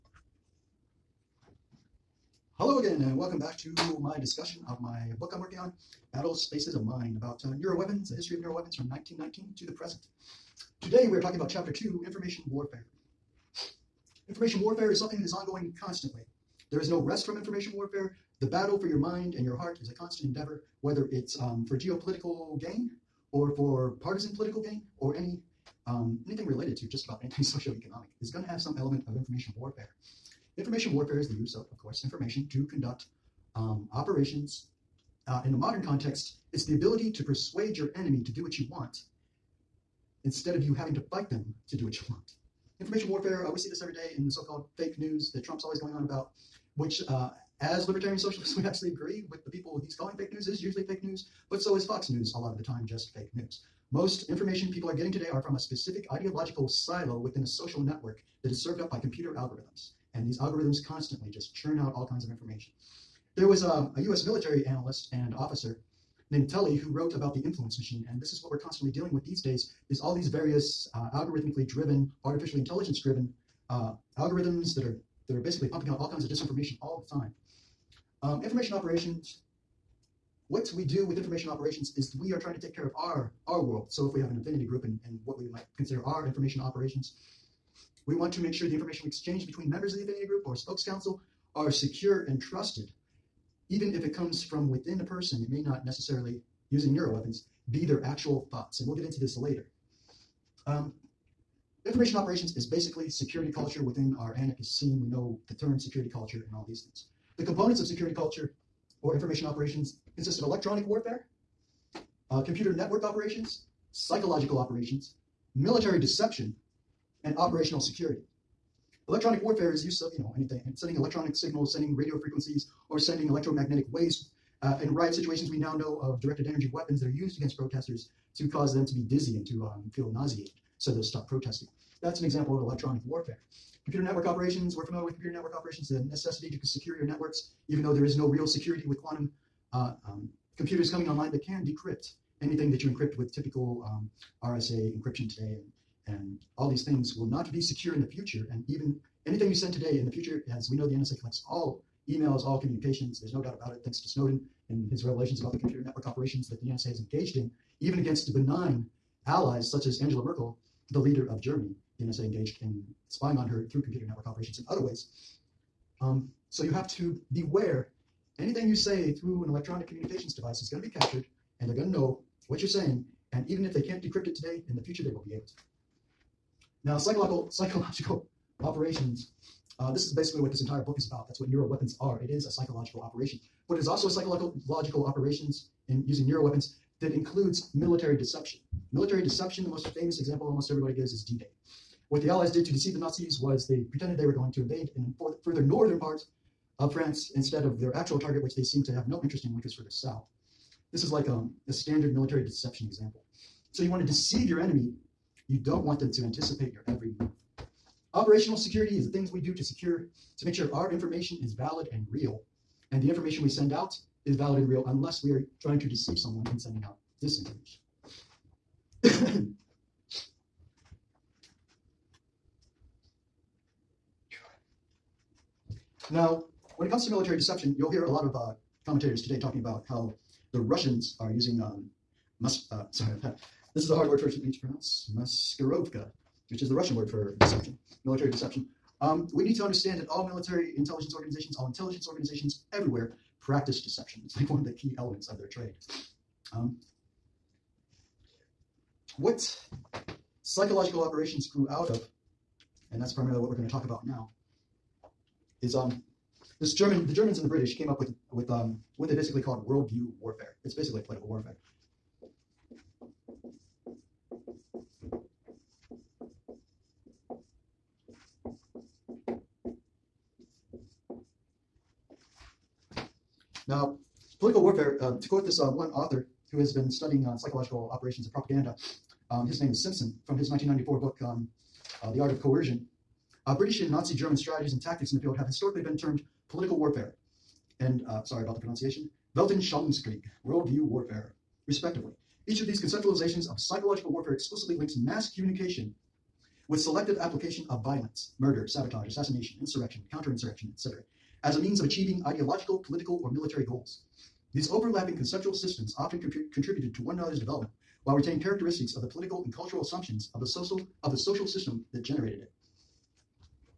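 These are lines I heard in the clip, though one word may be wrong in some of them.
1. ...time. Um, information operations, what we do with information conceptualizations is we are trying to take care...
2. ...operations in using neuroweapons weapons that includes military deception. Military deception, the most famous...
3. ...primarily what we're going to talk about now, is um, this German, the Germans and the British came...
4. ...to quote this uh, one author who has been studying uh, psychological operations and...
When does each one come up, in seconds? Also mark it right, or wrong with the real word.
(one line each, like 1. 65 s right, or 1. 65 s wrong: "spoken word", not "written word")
1. 77 s wrong: "operations", not "conceptualizations"
2. 185 s right
3. 253 s right
4. 275 s right.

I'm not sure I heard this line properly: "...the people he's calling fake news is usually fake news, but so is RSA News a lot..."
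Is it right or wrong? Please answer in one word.
wrong.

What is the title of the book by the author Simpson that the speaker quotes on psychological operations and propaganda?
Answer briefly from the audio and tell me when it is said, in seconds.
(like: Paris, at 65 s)
The Art of Coercion, at 282 s.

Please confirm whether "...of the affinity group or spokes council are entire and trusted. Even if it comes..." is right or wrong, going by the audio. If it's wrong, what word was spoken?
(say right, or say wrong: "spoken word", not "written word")
wrong: "secure", not "entire".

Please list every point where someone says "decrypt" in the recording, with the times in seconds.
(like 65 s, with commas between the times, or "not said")
141 s, 174 s.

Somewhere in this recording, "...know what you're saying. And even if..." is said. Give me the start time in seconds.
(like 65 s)
171 s.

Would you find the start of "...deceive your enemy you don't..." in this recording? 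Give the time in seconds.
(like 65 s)
204 s.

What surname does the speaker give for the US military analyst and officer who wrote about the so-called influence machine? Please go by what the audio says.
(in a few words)
Tully.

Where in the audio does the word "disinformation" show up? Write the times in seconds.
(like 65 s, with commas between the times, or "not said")
76 s, 217 s.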